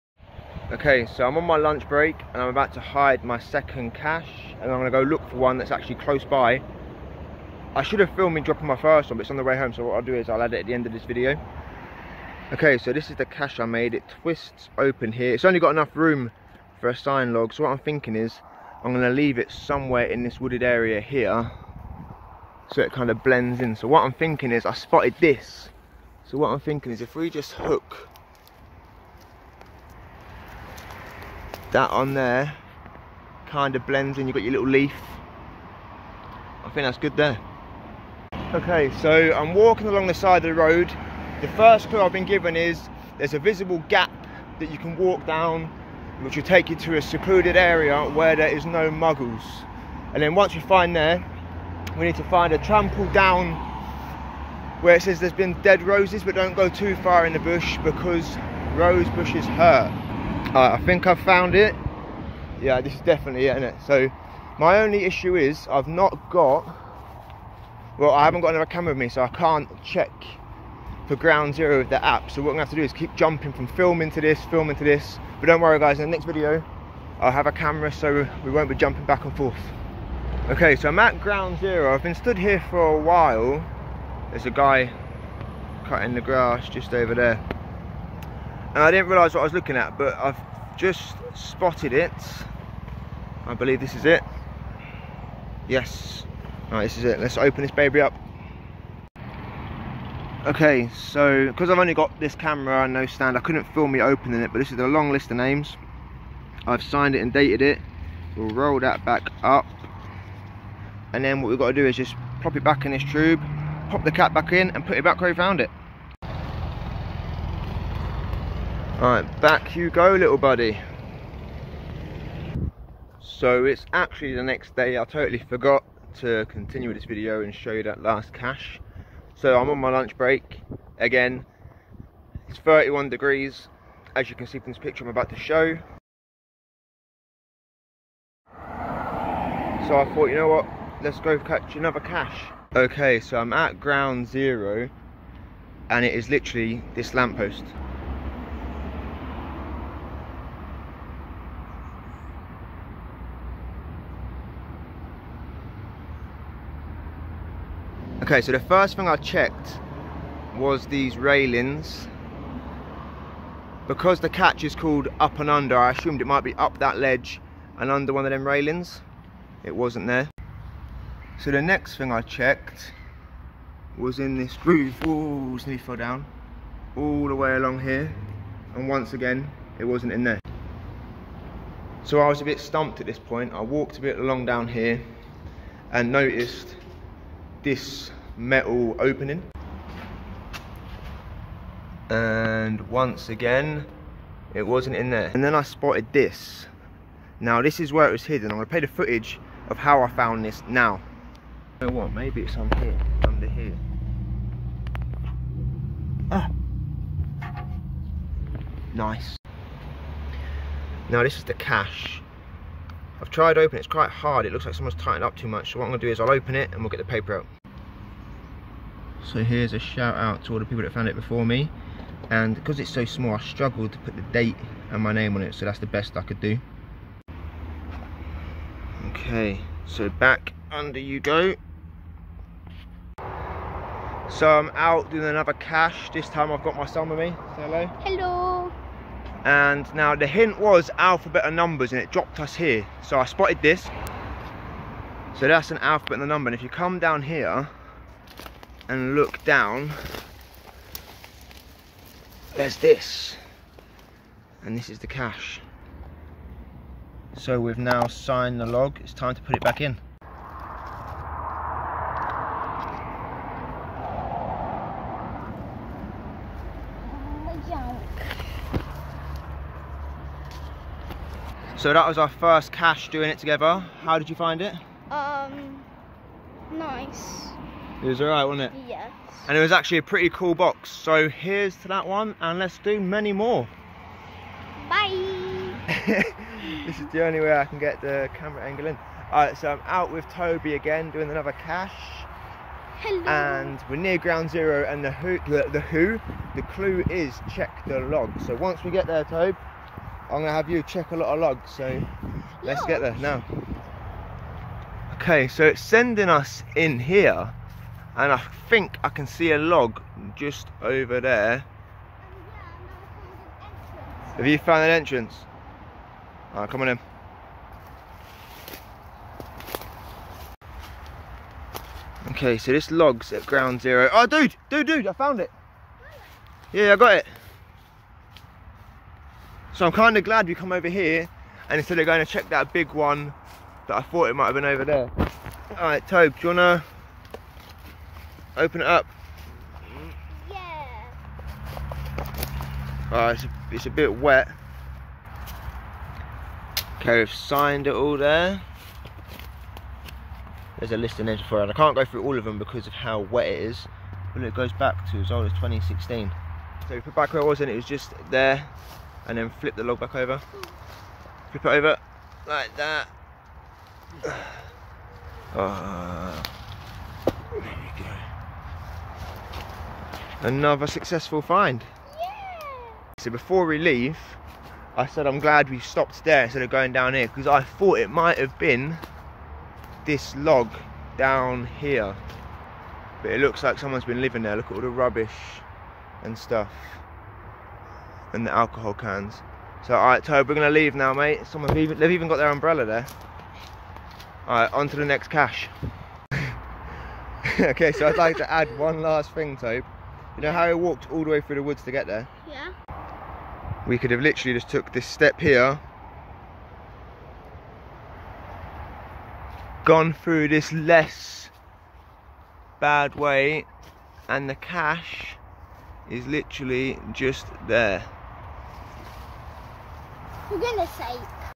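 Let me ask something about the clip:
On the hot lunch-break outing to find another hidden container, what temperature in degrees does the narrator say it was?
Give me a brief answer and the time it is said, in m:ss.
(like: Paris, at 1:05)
31 degrees, at 2:12.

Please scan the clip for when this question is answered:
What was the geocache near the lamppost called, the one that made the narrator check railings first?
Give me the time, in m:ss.
2:45.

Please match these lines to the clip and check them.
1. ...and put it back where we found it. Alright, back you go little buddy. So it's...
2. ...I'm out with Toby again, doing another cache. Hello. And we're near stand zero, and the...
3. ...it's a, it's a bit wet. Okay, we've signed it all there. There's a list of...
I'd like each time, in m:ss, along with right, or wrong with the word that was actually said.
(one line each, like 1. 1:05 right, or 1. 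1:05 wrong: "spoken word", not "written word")
1. 1:54 right
2. 4:49 wrong: "ground", not "stand"
3. 5:43 right.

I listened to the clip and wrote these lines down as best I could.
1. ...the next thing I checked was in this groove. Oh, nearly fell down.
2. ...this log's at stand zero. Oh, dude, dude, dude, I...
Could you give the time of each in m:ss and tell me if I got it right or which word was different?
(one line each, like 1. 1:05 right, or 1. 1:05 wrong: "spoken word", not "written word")
1. 2:51 right
2. 5:22 wrong: "ground", not "stand".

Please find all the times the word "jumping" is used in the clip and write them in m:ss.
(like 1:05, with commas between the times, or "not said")
1:13, 1:18.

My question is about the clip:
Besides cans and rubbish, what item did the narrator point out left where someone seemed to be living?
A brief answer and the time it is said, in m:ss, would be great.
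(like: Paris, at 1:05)
Umbrella, at 6:32.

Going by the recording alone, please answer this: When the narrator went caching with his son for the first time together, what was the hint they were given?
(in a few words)
Alphabet and numbers.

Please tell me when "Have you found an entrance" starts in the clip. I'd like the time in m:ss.
5:14.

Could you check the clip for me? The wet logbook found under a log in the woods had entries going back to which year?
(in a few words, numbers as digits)
2016.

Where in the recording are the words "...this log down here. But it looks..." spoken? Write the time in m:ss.
6:20.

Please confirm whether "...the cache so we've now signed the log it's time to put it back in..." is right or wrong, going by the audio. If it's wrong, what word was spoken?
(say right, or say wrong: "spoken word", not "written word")
right.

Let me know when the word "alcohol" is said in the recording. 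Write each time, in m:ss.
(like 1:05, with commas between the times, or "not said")
6:28.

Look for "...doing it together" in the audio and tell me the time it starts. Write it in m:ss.
4:33.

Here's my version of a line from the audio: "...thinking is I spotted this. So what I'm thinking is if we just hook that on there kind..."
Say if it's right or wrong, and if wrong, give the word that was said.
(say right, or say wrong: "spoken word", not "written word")
right.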